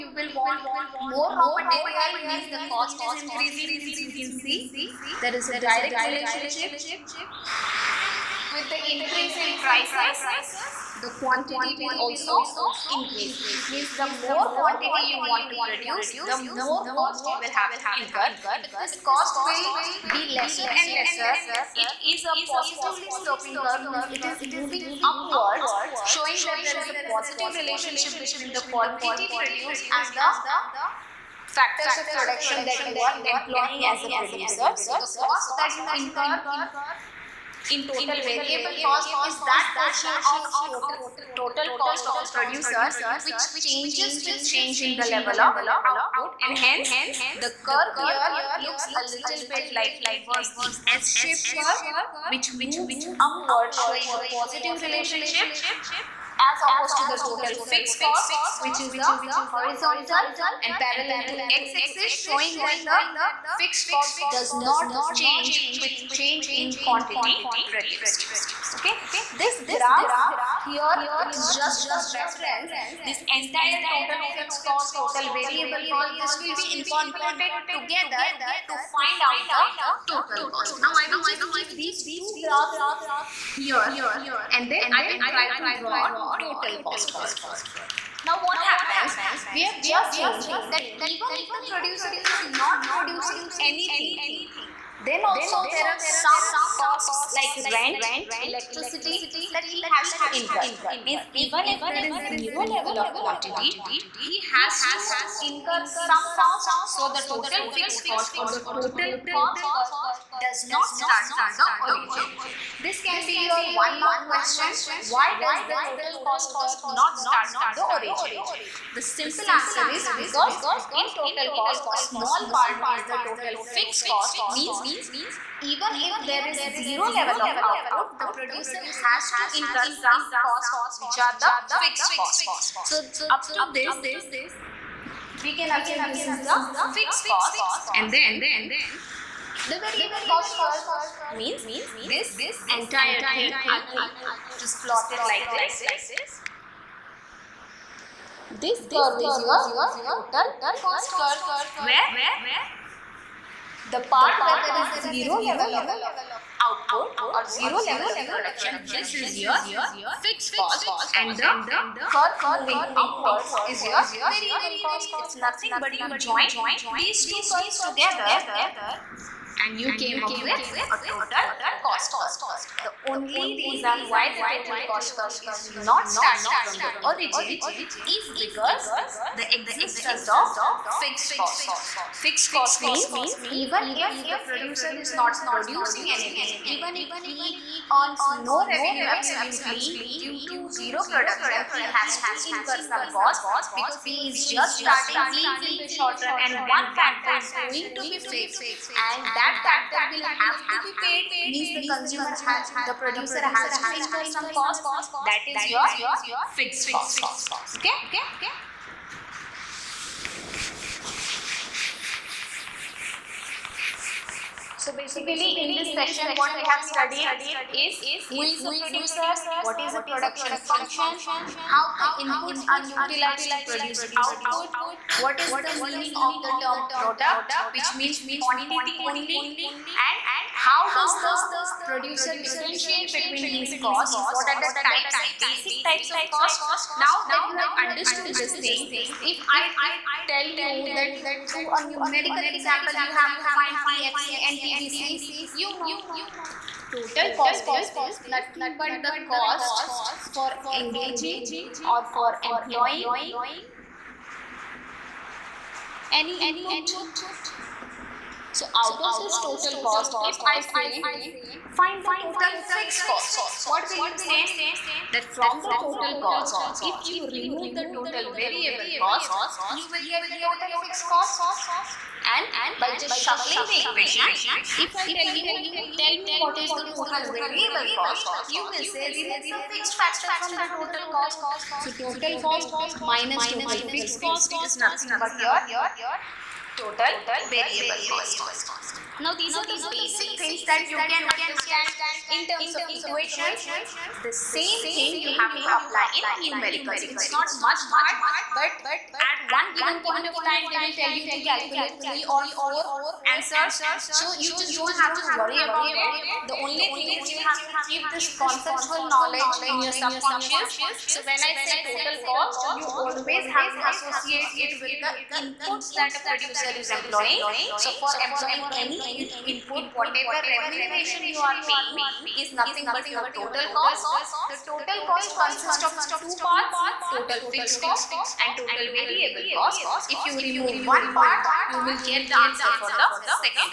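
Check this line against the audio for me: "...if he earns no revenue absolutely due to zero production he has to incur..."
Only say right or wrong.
right.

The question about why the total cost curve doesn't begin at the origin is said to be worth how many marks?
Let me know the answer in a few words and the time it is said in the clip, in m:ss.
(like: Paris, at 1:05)
1, at 1:53.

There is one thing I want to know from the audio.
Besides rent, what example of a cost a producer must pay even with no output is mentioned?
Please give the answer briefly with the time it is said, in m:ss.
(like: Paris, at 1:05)
Electricity, at 1:38.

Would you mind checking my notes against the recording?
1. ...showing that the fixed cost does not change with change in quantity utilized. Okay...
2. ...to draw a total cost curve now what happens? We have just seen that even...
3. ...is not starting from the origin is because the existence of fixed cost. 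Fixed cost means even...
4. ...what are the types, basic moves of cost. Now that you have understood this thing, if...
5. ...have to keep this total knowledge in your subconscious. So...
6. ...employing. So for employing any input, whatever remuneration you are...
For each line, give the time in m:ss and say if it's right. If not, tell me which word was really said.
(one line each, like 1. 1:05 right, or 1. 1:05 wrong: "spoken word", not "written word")
1. 1:02 wrong: "produced", not "utilized"
2. 1:25 right
3. 2:55 right
4. 3:54 wrong: "types", not "moves"
5. 5:07 wrong: "conceptual", not "total"
6. 5:16 right.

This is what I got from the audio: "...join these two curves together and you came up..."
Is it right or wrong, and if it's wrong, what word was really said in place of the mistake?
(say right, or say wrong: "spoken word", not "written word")
right.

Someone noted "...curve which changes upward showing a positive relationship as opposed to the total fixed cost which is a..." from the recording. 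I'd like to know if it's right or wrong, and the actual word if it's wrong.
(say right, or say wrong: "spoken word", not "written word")
wrong: "moves", not "changes".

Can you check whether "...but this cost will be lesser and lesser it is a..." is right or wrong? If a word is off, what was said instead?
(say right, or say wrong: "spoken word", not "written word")
right.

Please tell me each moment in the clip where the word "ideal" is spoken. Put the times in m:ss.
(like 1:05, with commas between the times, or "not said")
not said.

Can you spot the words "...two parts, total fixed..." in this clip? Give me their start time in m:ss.
5:26.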